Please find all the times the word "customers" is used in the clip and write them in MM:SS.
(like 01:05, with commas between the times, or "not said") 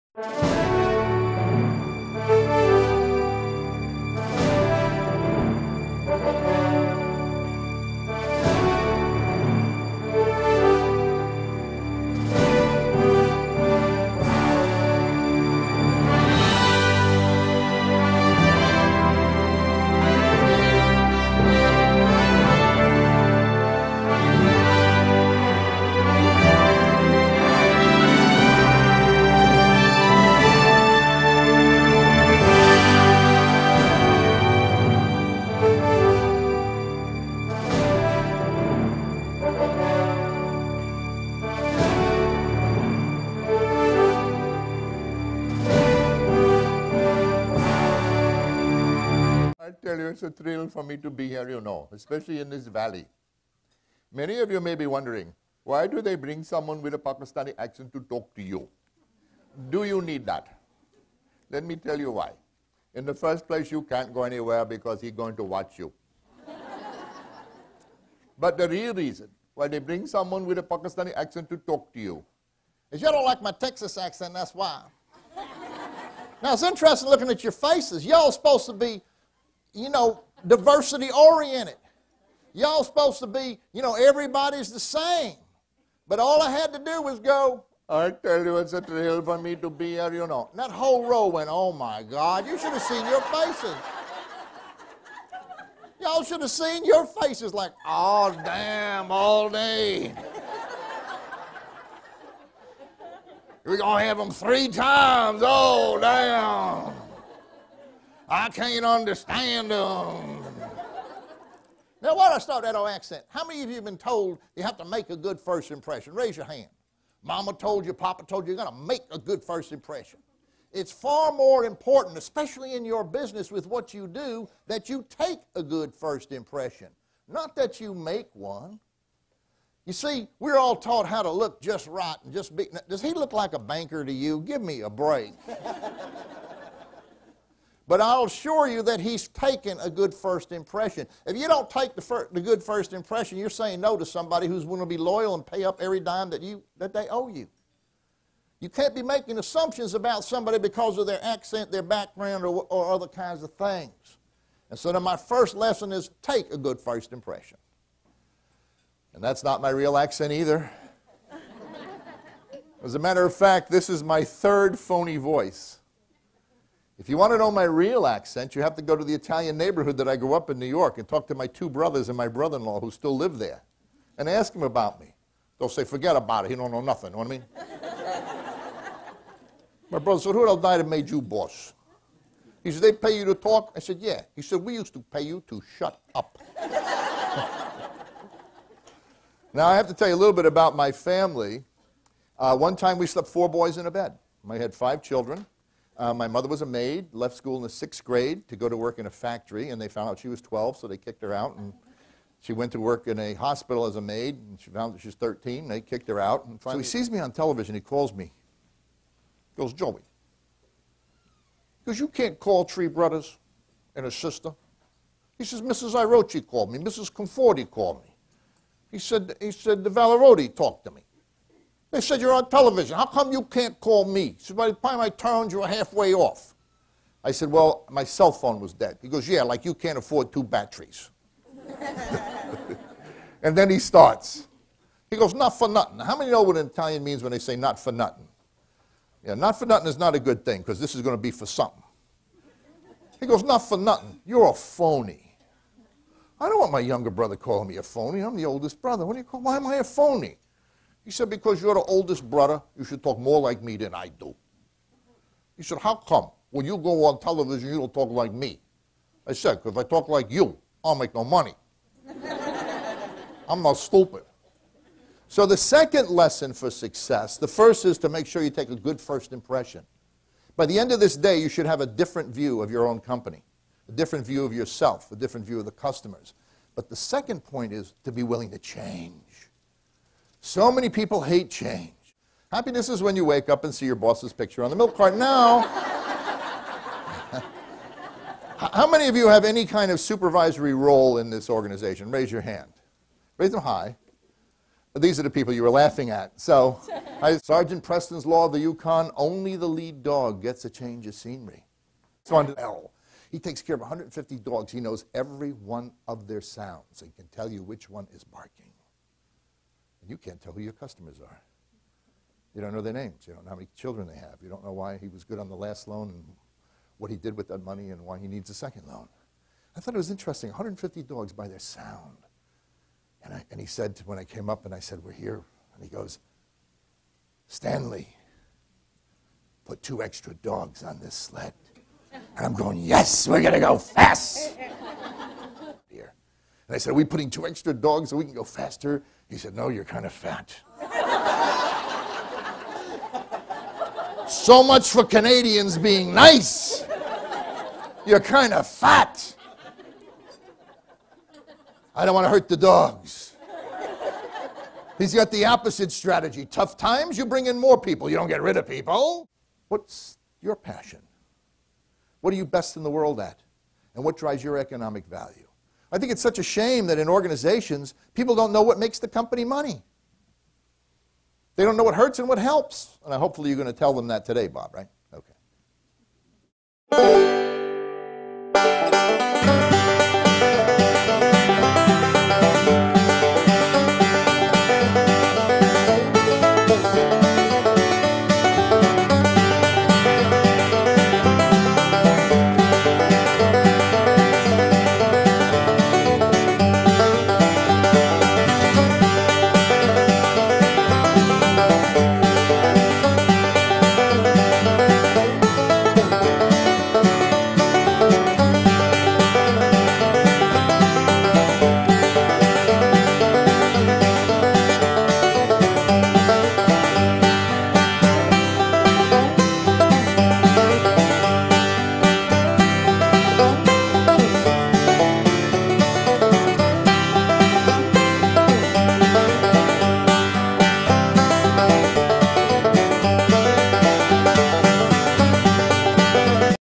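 04:35, 05:10.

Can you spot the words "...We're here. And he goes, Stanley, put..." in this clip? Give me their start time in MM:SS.
05:25.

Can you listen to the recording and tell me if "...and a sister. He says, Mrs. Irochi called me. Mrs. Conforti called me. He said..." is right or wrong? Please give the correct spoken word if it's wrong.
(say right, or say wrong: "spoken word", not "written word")
right.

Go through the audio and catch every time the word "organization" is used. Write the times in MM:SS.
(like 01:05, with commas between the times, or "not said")
04:51, 06:07.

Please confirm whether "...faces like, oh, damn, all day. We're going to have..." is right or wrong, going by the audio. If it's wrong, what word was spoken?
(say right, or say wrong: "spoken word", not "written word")
right.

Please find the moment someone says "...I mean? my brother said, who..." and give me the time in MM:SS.
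02:57.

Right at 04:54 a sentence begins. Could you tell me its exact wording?
These are the people you were laughing at.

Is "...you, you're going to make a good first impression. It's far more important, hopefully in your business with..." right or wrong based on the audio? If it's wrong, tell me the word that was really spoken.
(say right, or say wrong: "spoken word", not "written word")
wrong: "especially", not "hopefully".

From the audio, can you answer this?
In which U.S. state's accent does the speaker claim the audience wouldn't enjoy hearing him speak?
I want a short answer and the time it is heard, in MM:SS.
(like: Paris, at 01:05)
Texas, at 01:13.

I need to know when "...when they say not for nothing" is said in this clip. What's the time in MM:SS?
03:57.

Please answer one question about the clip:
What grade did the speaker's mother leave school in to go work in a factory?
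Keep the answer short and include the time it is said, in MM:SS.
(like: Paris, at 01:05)
sixth grade, at 03:17.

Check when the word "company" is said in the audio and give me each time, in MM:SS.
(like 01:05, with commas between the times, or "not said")
04:32, 06:09.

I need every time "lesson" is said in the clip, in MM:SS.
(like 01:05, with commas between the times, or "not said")
02:35, 04:26.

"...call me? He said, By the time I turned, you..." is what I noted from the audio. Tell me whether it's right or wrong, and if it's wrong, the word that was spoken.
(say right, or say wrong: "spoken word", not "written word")
right.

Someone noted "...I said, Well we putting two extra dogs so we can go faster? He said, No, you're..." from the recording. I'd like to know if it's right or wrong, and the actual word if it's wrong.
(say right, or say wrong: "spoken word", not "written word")
wrong: "Are", not "Well".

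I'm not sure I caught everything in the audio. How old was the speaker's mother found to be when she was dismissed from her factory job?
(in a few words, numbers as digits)
12.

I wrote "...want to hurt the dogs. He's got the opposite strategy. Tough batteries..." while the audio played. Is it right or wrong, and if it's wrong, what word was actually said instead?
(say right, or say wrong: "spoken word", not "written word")
wrong: "times", not "batteries".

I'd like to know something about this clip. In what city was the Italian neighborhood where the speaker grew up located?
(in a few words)
New York.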